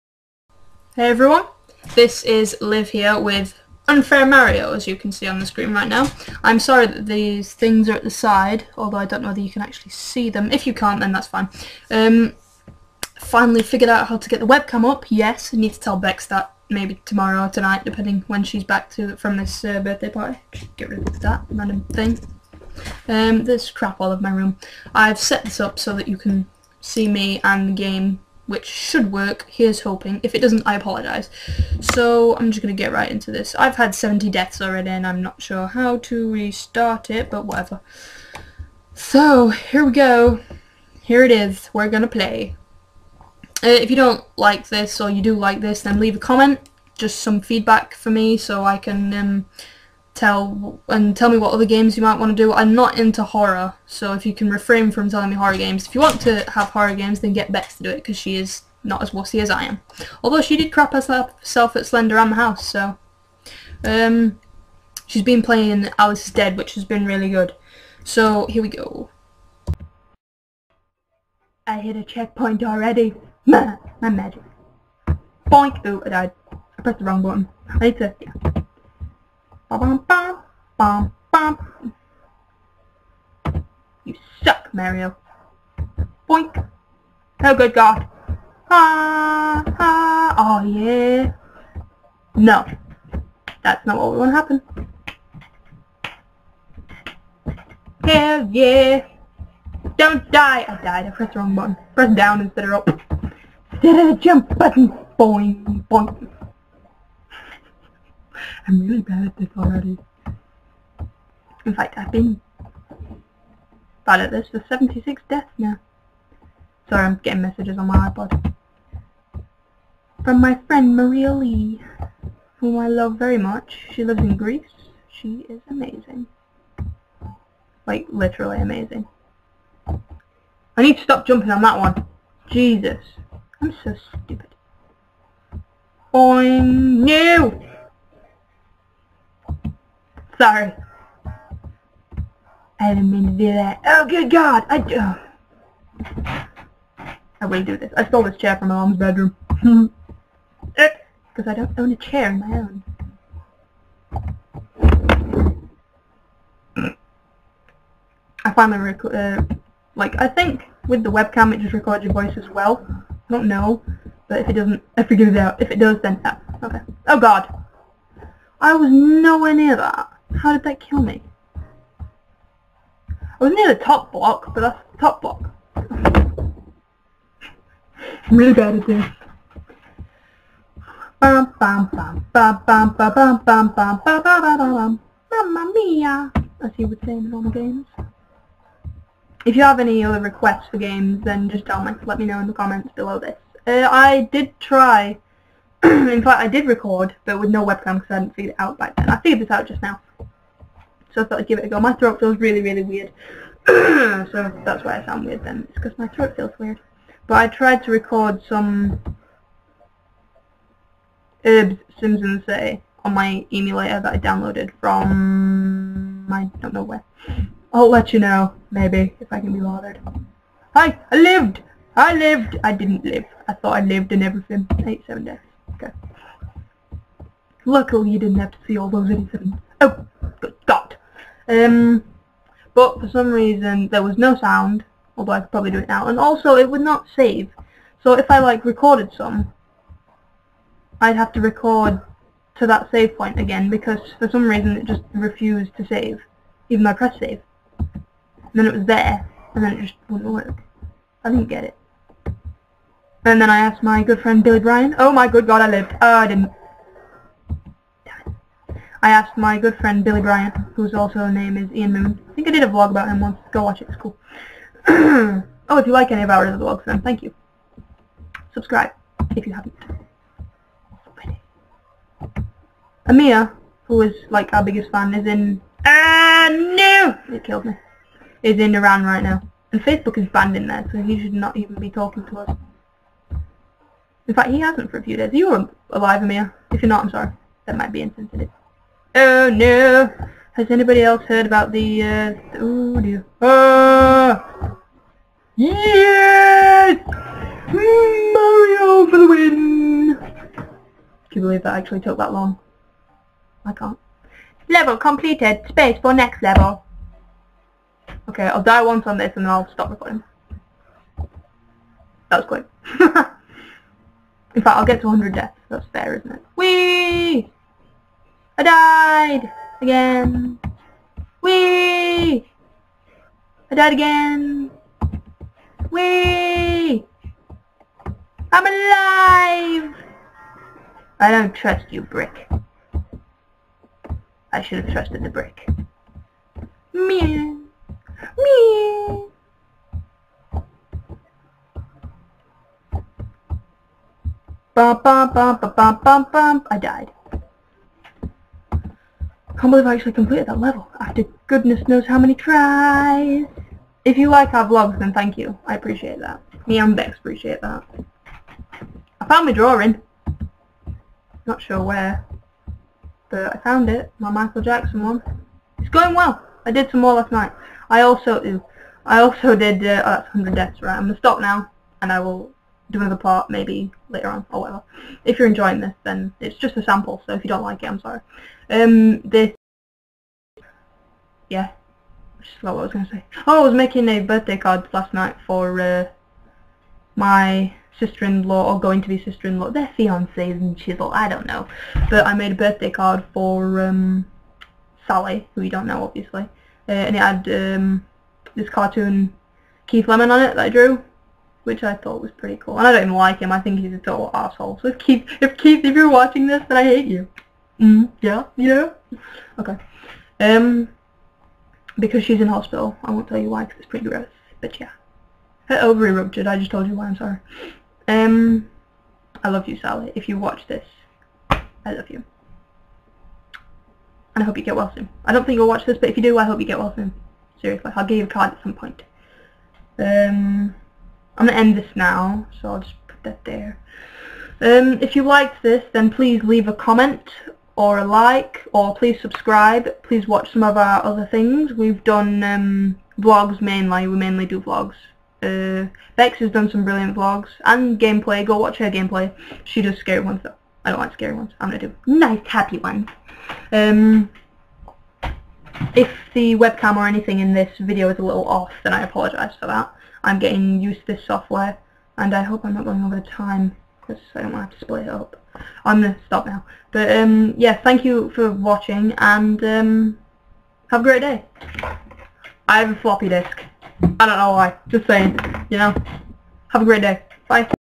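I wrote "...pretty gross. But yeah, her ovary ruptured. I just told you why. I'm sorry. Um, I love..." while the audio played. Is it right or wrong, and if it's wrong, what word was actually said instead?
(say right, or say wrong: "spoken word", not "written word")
right.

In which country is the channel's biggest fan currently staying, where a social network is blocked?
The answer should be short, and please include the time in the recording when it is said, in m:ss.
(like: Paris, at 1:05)
Iran, at 4:38.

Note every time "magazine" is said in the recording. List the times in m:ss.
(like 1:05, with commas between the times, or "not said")
not said.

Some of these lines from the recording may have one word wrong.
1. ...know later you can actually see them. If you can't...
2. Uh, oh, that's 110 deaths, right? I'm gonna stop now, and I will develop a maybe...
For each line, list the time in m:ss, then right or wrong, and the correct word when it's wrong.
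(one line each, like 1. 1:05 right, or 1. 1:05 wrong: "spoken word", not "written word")
1. 0:09 wrong: "whether", not "later"
2. 6:09 wrong: "100", not "110".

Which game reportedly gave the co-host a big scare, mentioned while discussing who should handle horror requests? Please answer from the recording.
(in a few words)
Slender the House.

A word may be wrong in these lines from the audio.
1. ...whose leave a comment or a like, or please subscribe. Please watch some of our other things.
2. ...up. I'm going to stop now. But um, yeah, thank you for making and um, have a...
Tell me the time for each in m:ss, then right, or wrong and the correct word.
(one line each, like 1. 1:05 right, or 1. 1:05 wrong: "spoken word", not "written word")
1. 7:16 wrong: "please", not "whose"
2. 7:45 wrong: "watching", not "making".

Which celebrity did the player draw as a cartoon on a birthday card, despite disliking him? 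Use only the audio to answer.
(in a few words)
Keith Lemon.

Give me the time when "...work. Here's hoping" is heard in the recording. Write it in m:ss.
0:29.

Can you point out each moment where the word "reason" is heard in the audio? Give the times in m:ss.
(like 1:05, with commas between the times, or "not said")
3:53, 4:04.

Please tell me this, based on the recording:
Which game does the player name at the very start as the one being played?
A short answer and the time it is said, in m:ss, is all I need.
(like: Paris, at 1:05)
Unfair Mario, at 0:03.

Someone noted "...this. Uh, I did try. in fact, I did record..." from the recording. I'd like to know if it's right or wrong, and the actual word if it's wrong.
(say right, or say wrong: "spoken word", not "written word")
right.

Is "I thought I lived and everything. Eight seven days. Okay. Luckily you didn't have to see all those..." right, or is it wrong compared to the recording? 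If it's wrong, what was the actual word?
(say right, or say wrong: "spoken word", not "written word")
right.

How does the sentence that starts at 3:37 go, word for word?
I'll let you know, maybe, if I can be bothered.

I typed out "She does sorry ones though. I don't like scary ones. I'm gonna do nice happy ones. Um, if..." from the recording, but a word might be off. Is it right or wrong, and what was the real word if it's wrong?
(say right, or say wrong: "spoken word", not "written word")
wrong: "scary", not "sorry".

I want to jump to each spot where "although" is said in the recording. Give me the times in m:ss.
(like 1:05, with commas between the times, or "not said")
0:08, 1:00, 3:55.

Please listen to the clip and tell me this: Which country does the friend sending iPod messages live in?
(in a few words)
Greece.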